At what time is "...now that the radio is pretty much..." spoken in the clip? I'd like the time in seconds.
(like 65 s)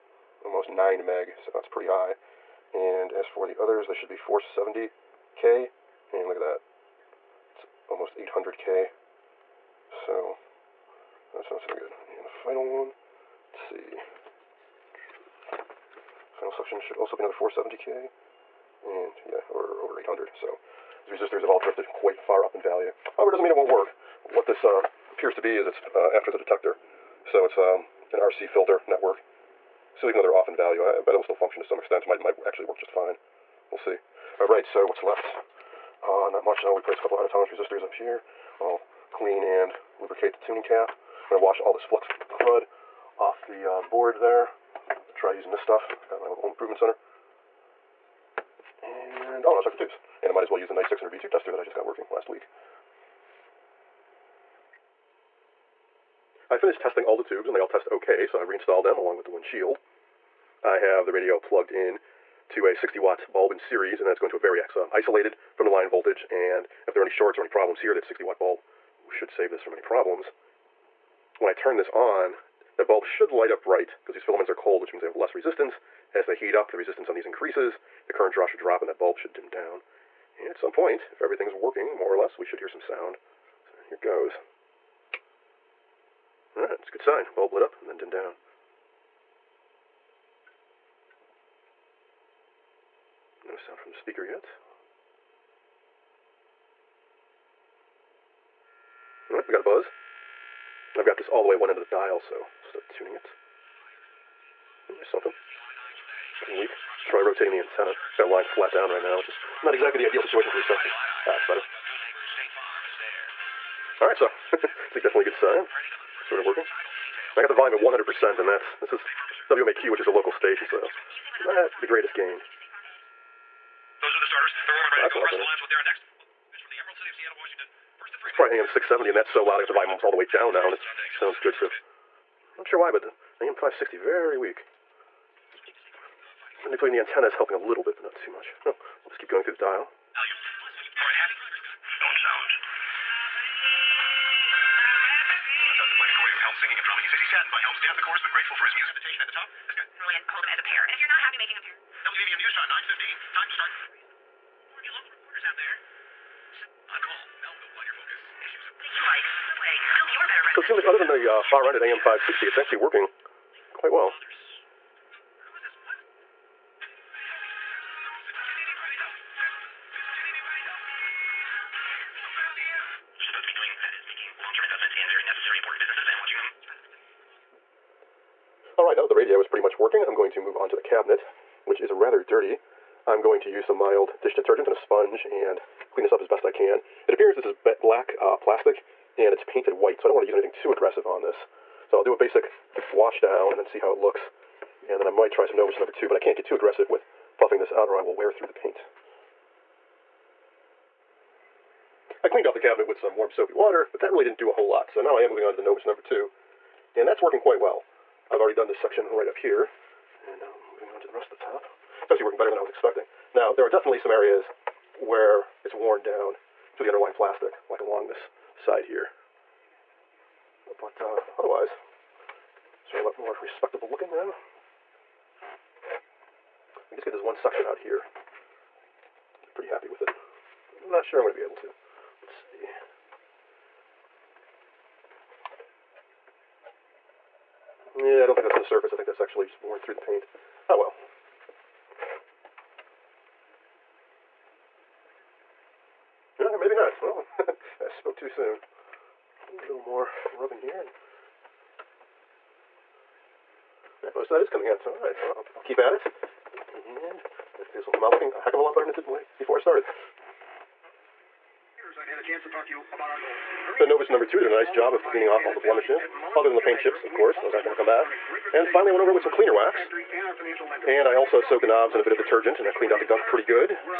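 178 s.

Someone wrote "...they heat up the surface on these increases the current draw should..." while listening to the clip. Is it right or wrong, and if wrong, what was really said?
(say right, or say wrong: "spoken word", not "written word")
wrong: "resistance", not "surface".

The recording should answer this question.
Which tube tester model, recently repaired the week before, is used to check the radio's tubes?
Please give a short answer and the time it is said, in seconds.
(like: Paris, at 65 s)
Knight 600 V2, at 50 s.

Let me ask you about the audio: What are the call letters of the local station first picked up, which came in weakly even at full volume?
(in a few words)
WMAQ.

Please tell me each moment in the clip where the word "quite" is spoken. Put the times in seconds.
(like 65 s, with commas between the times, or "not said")
21 s, 207 s.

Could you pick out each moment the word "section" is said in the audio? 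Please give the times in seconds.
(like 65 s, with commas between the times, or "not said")
208 s, 227 s.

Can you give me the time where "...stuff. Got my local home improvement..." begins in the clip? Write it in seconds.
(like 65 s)
45 s.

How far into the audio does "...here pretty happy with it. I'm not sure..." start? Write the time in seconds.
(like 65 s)
227 s.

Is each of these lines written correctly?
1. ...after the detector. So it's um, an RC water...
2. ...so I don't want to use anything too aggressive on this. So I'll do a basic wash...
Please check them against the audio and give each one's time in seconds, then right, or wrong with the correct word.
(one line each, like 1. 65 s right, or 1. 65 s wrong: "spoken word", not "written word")
1. 26 s wrong: "filter", not "water"
2. 189 s right.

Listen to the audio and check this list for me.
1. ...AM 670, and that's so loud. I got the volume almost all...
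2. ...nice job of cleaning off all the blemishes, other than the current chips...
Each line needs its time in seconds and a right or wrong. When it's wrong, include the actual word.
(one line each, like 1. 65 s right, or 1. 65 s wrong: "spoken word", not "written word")
1. 128 s right
2. 264 s wrong: "paint", not "current".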